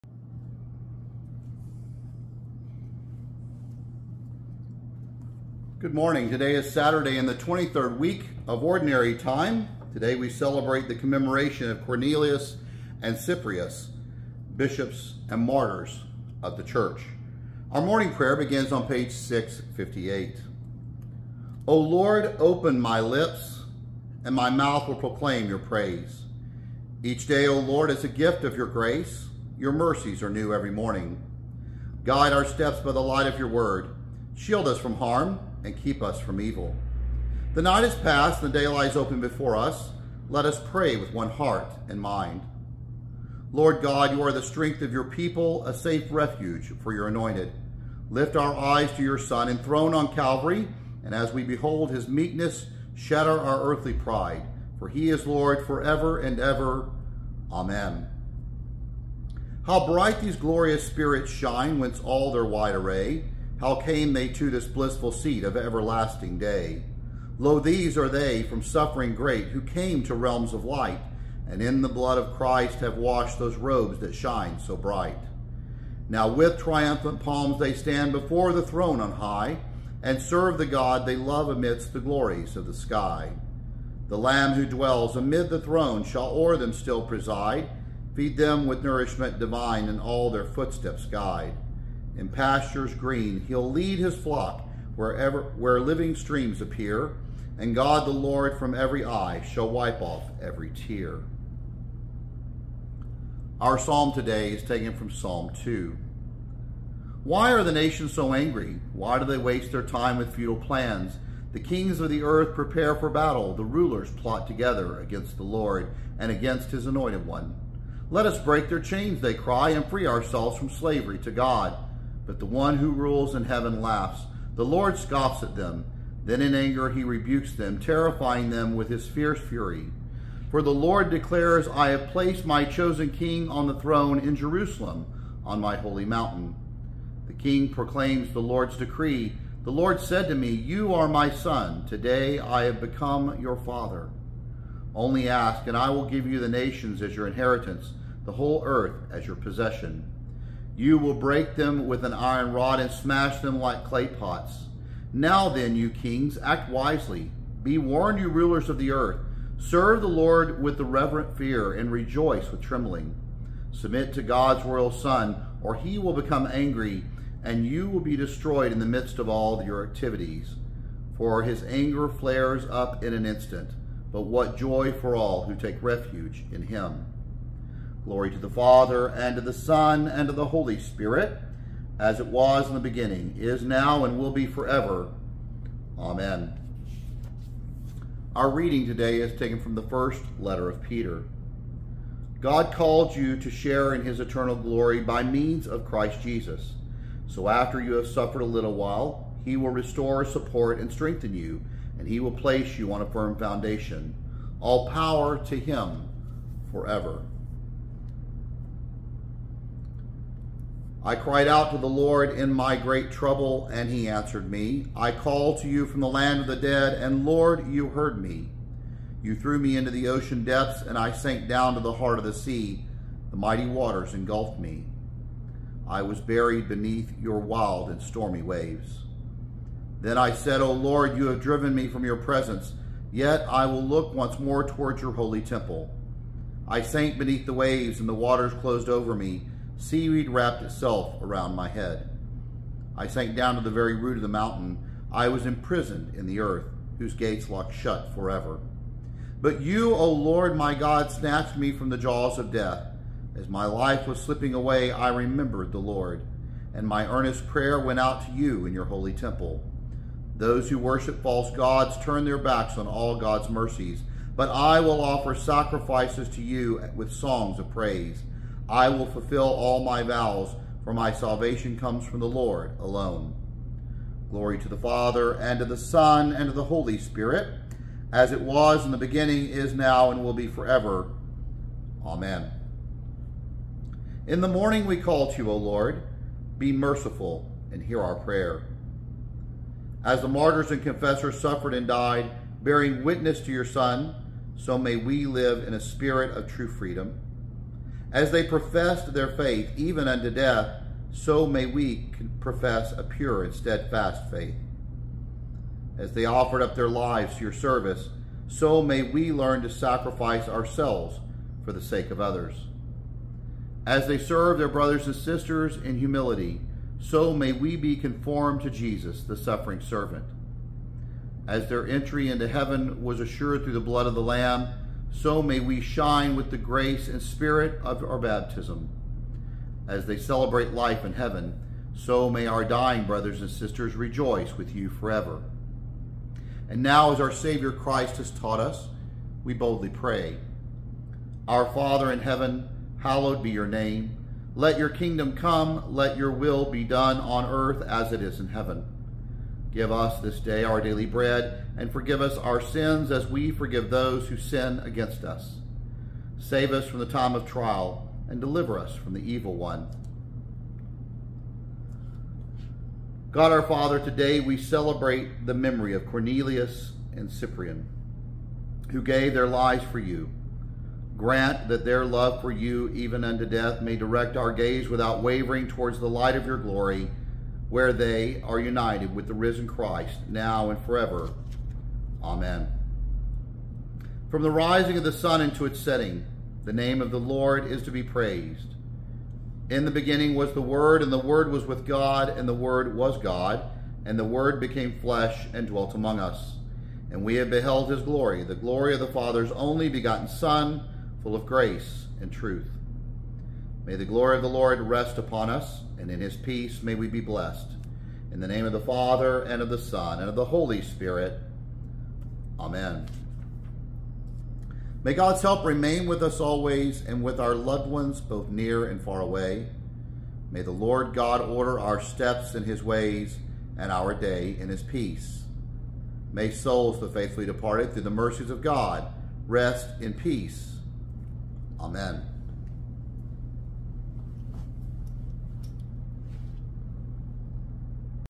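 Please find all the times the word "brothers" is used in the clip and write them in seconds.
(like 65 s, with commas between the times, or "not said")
314 s, 333 s.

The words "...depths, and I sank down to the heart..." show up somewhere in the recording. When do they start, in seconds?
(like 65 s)
220 s.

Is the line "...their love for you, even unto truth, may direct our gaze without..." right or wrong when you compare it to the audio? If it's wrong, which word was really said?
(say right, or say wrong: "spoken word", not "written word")
wrong: "death", not "truth".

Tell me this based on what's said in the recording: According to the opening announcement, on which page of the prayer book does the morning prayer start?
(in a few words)
658.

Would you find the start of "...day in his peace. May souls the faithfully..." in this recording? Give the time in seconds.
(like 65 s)
424 s.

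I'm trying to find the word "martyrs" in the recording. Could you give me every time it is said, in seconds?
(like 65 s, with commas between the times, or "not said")
15 s, 290 s.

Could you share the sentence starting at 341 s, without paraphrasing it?
Our Father in heaven, hallowed be your name.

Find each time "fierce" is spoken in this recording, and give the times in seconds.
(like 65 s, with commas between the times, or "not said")
129 s.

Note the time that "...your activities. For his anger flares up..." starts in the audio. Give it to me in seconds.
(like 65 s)
169 s.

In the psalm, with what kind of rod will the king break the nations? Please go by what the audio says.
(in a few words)
iron rod.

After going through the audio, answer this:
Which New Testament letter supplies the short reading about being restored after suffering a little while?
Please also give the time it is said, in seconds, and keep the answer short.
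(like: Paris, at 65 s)
First letter of Peter, at 189 s.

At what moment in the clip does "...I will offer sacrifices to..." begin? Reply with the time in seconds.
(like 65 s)
264 s.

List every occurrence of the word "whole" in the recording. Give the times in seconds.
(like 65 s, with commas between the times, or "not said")
148 s.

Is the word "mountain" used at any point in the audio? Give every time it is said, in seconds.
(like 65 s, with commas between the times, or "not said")
136 s, 244 s.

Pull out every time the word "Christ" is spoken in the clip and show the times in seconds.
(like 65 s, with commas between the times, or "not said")
72 s, 195 s, 337 s, 379 s.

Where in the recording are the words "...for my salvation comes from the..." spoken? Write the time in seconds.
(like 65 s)
270 s.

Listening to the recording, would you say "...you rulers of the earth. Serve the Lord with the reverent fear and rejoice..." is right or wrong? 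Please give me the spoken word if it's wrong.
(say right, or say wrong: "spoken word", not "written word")
right.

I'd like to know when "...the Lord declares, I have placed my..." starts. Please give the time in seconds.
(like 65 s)
130 s.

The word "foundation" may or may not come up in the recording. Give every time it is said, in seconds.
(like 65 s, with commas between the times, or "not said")
203 s.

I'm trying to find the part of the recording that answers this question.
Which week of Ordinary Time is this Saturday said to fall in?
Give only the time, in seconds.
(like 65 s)
7 s.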